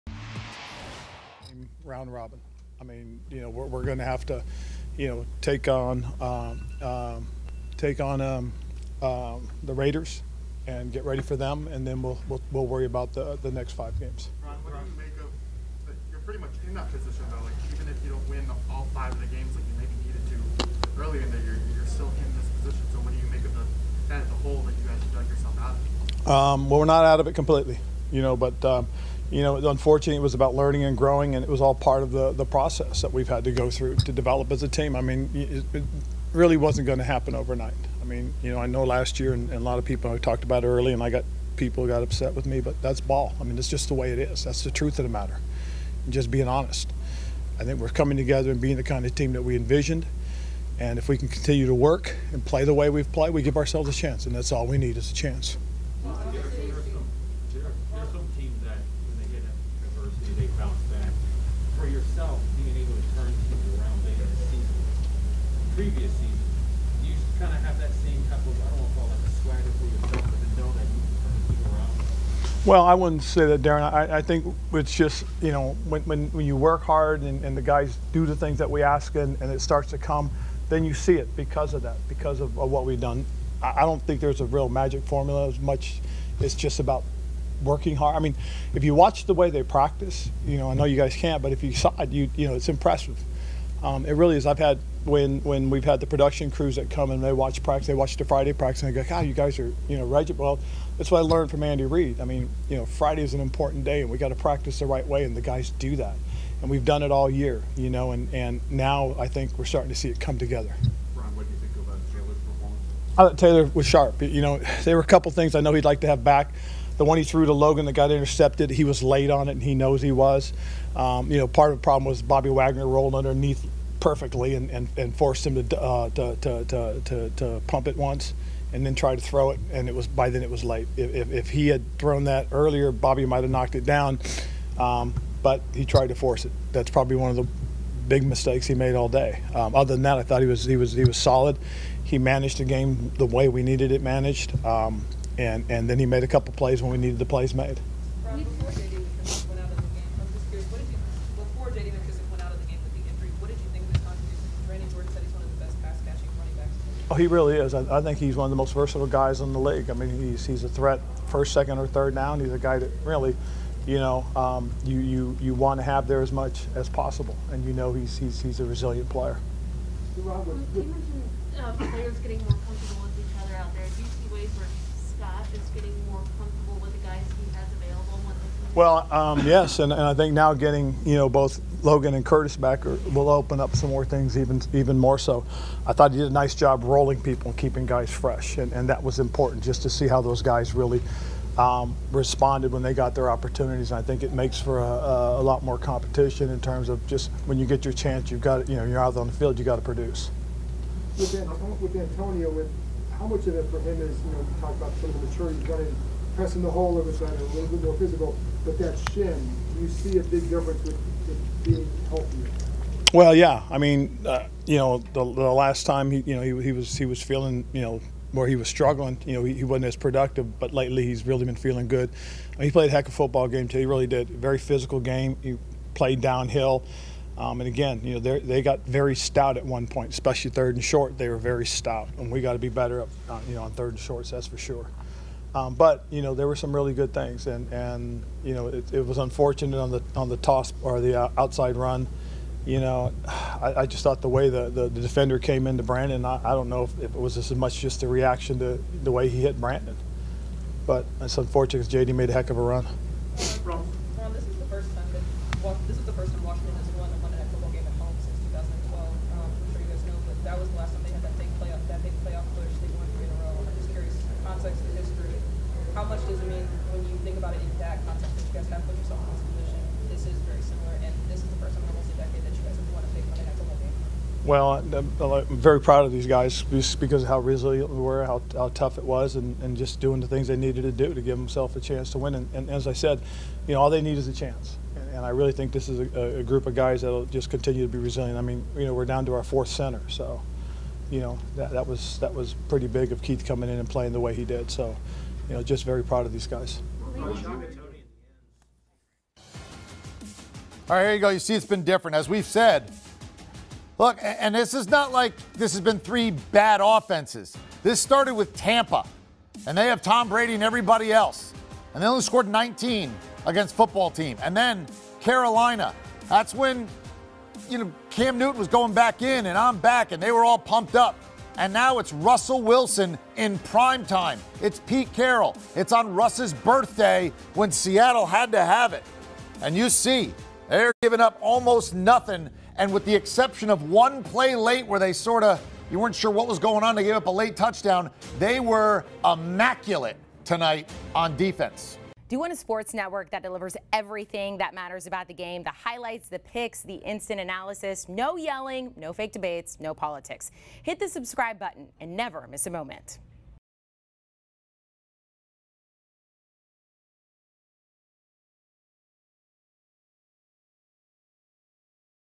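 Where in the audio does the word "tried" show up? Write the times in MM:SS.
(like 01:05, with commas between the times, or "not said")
02:08, 02:15.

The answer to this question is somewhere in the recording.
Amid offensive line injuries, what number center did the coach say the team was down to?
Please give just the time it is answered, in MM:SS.
04:49.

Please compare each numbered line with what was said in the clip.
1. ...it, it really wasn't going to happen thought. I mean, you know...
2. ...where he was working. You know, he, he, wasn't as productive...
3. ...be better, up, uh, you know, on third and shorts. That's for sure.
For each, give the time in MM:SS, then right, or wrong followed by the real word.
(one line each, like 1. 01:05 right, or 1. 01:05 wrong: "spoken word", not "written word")
1. 00:35 wrong: "overnight", not "thought"
2. 03:38 wrong: "struggling", not "working"
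3. 03:52 right.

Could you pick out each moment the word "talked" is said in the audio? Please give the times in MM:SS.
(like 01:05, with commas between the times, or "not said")
00:40, 03:24.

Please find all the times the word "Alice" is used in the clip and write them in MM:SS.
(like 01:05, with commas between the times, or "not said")
not said.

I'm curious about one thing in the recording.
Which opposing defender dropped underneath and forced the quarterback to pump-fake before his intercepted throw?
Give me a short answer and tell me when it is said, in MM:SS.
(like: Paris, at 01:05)
Bobby Wagner, at 02:02.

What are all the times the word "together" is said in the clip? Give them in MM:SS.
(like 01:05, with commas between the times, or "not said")
00:48, 01:50.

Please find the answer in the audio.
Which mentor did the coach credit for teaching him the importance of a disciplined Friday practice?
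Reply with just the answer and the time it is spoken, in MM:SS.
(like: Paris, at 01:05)
Andy Reid, at 01:41.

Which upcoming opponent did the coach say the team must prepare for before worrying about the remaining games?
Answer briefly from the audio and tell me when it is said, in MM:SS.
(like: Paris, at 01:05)
Raiders, at 00:09.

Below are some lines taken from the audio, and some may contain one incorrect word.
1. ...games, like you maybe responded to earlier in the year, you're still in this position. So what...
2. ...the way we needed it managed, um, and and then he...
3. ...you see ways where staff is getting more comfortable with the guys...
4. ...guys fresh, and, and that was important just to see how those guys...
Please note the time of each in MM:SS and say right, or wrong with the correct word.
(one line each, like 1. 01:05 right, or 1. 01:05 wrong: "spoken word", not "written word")
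1. 00:19 wrong: "needed", not "responded"
2. 02:23 right
3. 02:54 right
4. 03:07 right.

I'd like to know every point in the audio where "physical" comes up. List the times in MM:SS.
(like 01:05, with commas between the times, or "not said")
03:27, 03:44.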